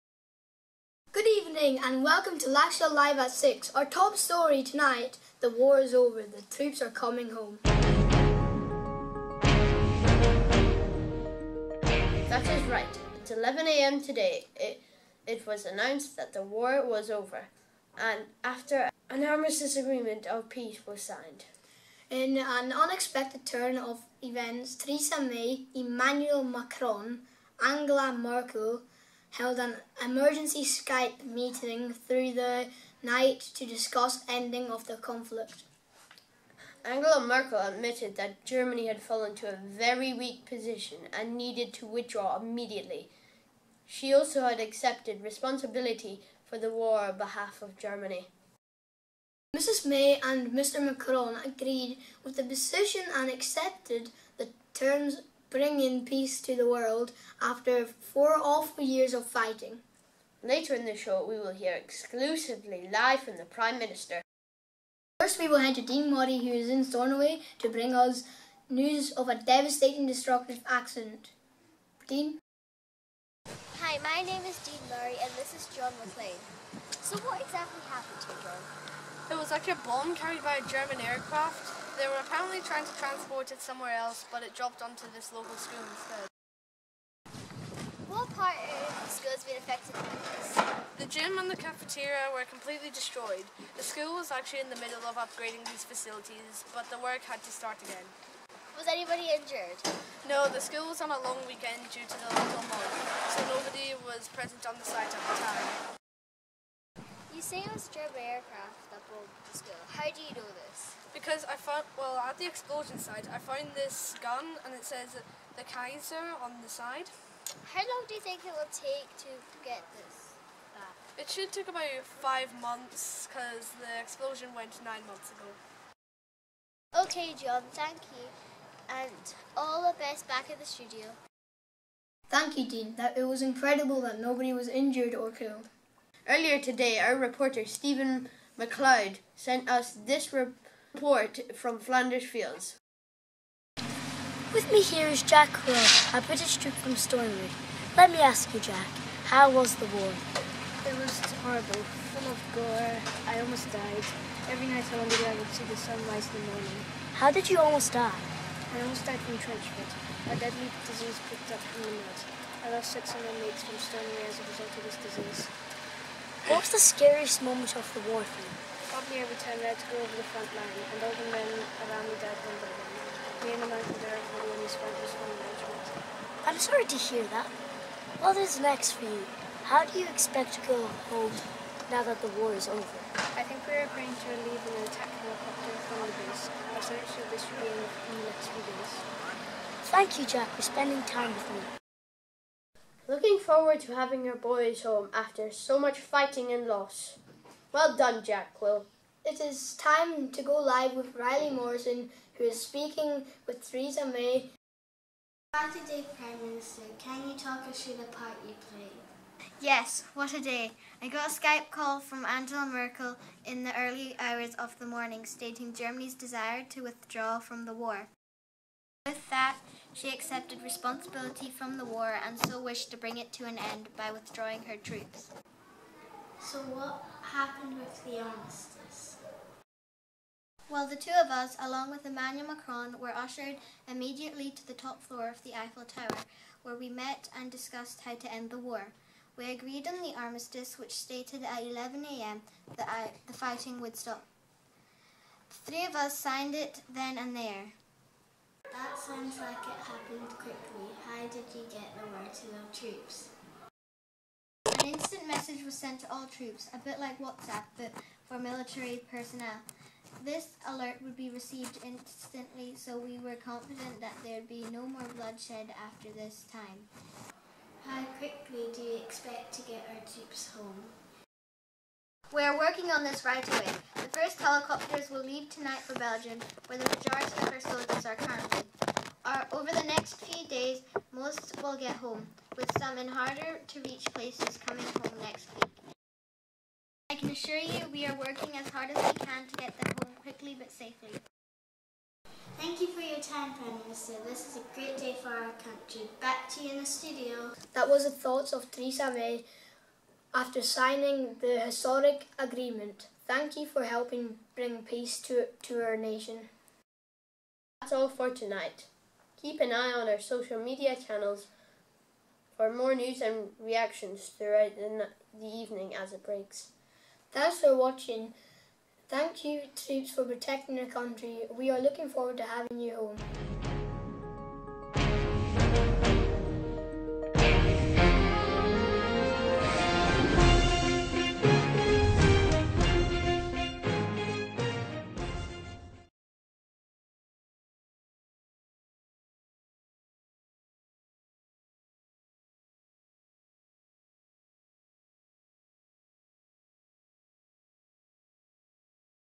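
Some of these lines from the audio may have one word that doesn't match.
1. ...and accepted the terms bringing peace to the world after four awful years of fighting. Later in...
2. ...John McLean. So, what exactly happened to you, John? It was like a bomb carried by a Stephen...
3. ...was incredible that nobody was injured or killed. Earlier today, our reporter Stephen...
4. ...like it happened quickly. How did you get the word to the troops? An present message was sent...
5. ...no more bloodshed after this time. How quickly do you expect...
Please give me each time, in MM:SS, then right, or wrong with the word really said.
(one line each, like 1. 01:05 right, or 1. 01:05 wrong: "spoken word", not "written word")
1. 00:53 right
2. 01:15 wrong: "German", not "Stephen"
3. 02:13 right
4. 04:09 wrong: "instant", not "present"
5. 04:24 right.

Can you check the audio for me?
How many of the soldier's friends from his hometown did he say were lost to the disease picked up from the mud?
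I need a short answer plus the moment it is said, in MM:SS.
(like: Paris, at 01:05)
6, at 02:42.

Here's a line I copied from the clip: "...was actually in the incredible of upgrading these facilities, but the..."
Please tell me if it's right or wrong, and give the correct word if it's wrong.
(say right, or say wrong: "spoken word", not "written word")
wrong: "middle", not "incredible".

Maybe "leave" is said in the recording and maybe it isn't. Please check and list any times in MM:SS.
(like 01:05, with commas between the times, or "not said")
03:04, 04:35.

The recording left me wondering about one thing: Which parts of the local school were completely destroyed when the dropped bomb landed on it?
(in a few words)
The gym and the cafeteria.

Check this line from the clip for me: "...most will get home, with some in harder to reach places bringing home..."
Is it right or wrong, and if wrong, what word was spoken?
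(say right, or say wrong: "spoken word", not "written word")
wrong: "coming", not "bringing".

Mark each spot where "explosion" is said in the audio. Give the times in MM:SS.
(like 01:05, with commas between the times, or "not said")
01:52, 02:04.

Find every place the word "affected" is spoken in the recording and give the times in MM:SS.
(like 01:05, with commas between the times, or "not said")
01:29.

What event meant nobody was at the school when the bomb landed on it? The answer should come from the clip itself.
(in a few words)
The local Mod.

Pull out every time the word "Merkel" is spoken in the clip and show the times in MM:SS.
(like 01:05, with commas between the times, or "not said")
00:28, 00:37, 03:32.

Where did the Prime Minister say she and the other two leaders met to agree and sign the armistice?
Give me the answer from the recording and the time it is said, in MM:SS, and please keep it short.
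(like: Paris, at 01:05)
The Eiffel Tower, at 03:55.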